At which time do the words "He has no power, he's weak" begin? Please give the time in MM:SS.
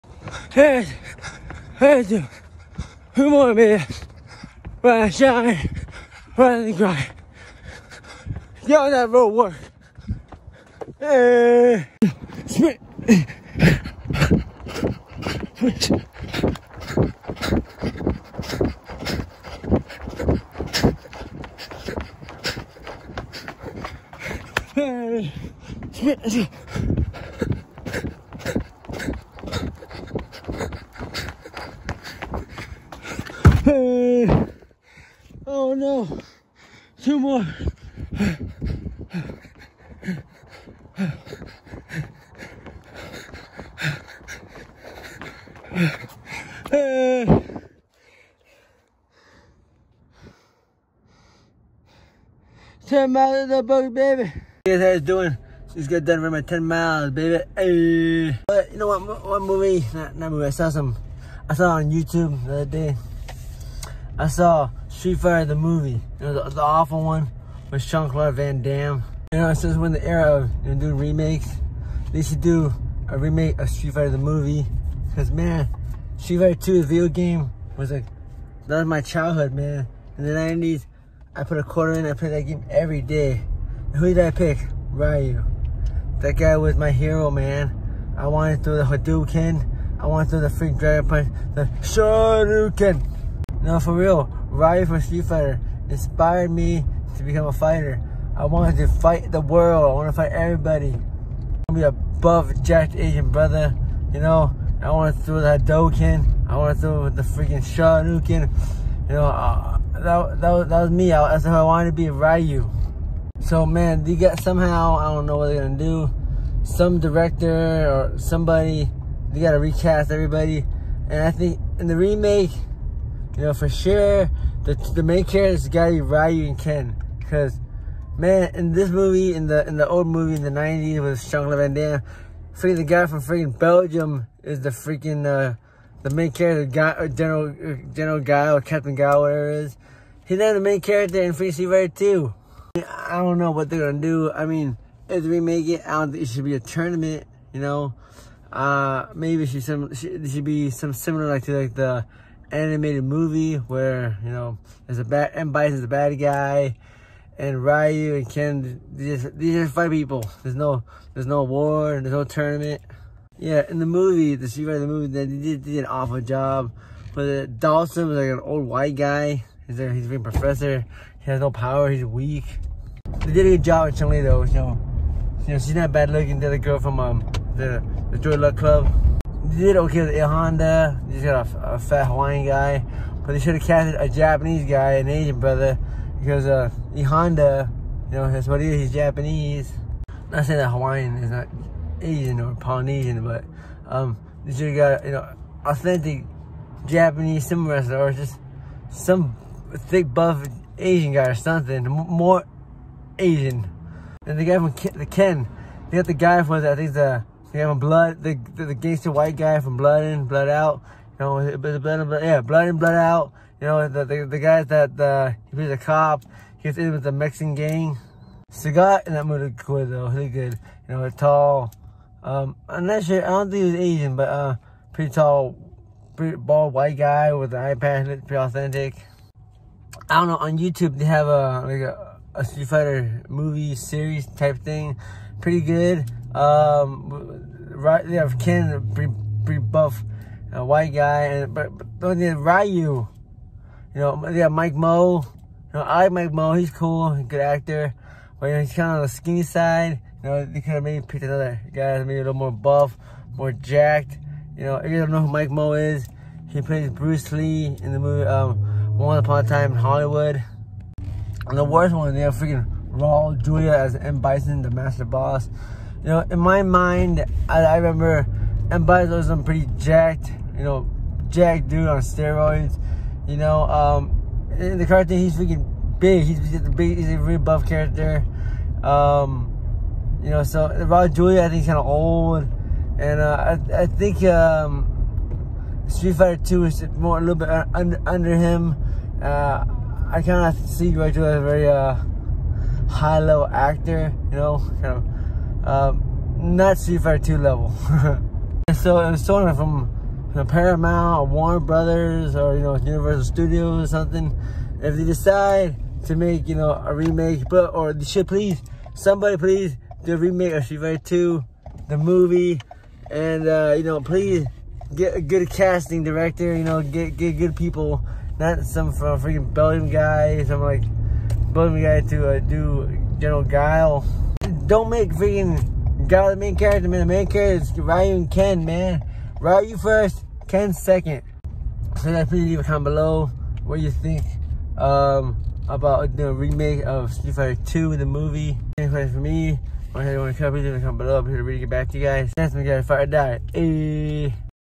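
02:51.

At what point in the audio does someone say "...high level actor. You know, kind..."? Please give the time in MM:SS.
04:52.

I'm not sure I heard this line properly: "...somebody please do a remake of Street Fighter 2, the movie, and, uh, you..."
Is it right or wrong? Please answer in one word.
right.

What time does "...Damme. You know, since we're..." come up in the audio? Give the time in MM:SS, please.
01:08.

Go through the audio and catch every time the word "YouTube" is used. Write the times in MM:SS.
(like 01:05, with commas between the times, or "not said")
01:01, 03:50.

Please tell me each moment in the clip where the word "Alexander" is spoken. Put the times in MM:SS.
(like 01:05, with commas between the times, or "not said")
not said.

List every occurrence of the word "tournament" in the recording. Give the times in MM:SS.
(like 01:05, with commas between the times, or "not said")
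02:26, 02:42.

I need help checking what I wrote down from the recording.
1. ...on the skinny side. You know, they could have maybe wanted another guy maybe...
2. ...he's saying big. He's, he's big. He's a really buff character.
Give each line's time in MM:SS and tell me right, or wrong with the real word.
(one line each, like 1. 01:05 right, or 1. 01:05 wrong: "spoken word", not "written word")
1. 04:08 wrong: "picked", not "wanted"
2. 04:35 wrong: "freaking", not "saying".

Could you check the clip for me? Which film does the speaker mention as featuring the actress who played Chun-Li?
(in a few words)
The Joy Luck Club.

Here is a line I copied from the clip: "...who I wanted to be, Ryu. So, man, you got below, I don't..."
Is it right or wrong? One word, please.
wrong.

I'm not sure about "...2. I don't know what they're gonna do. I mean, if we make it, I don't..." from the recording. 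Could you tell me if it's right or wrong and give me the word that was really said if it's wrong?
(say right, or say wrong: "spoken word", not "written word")
right.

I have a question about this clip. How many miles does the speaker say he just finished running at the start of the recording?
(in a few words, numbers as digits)
10.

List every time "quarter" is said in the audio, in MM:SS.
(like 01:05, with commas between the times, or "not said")
01:21.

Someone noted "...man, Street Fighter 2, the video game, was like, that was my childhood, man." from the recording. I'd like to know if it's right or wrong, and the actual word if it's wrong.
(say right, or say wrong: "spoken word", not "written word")
right.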